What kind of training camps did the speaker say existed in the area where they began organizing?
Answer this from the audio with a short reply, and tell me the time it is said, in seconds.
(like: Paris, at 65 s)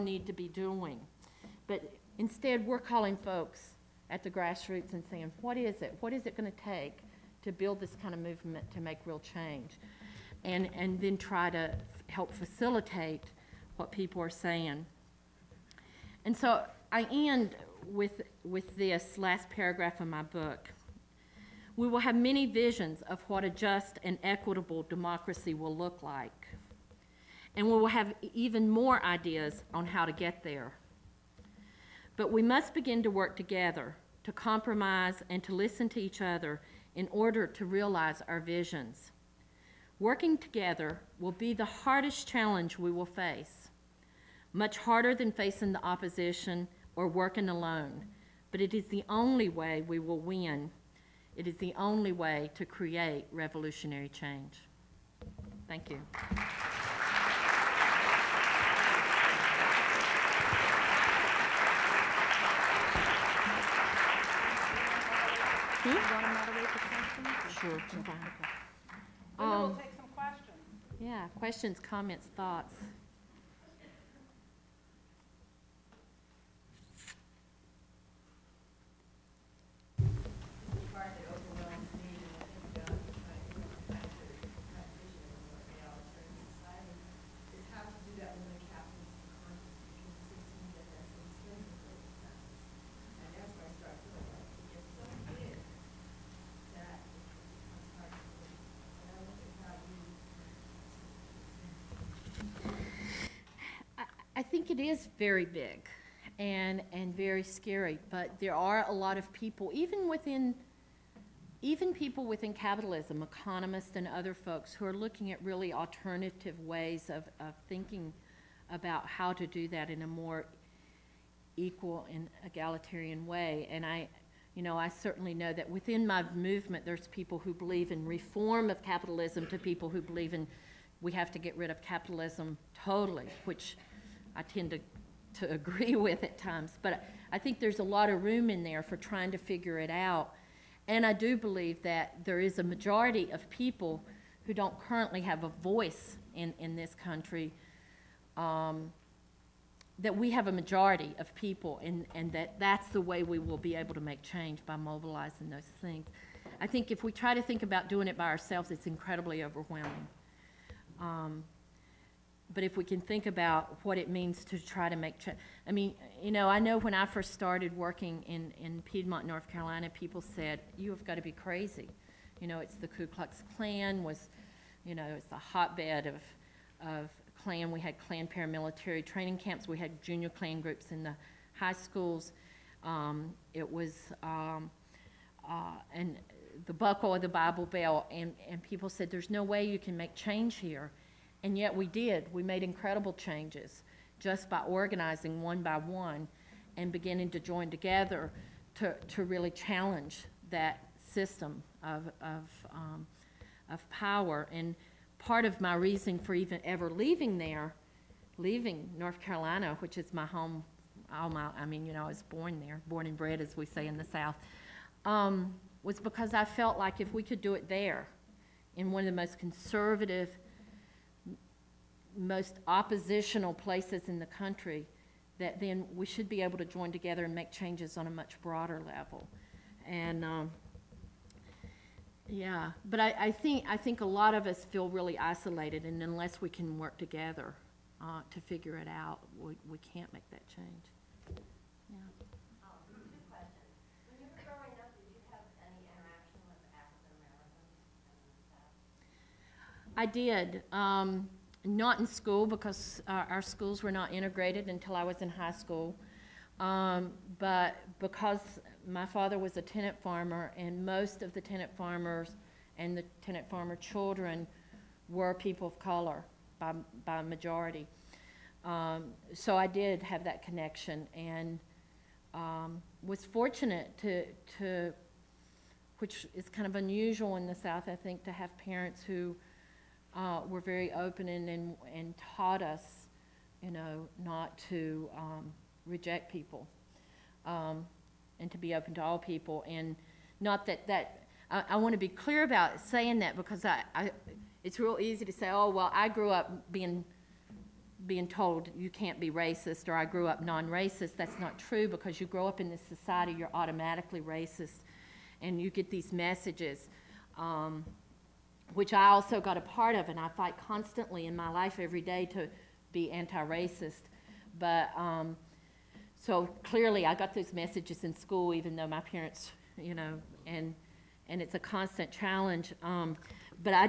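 Klan paramilitary training camps, at 177 s.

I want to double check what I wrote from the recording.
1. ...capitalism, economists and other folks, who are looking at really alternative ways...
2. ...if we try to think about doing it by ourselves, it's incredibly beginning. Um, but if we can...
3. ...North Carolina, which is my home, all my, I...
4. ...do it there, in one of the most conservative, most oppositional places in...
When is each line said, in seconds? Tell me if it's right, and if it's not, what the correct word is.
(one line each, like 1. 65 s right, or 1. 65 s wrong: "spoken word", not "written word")
1. 112 s right
2. 156 s wrong: "overwhelming", not "beginning"
3. 208 s right
4. 217 s right.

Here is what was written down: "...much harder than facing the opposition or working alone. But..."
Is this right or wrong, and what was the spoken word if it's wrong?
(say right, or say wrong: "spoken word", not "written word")
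right.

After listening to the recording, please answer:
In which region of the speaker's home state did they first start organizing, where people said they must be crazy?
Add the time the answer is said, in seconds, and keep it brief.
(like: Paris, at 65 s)
Piedmont, North Carolina, at 168 s.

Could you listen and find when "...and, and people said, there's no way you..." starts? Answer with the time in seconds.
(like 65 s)
188 s.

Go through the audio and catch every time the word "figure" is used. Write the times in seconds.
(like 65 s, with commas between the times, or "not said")
139 s, 238 s.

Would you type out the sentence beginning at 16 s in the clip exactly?
And so I end with, with this last paragraph of my book.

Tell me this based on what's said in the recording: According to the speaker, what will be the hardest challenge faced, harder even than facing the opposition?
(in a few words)
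Working together.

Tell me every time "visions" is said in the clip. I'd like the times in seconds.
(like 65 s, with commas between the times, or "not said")
22 s, 38 s.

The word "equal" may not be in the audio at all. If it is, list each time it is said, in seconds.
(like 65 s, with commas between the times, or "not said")
121 s.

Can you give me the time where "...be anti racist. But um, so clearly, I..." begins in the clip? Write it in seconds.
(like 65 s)
312 s.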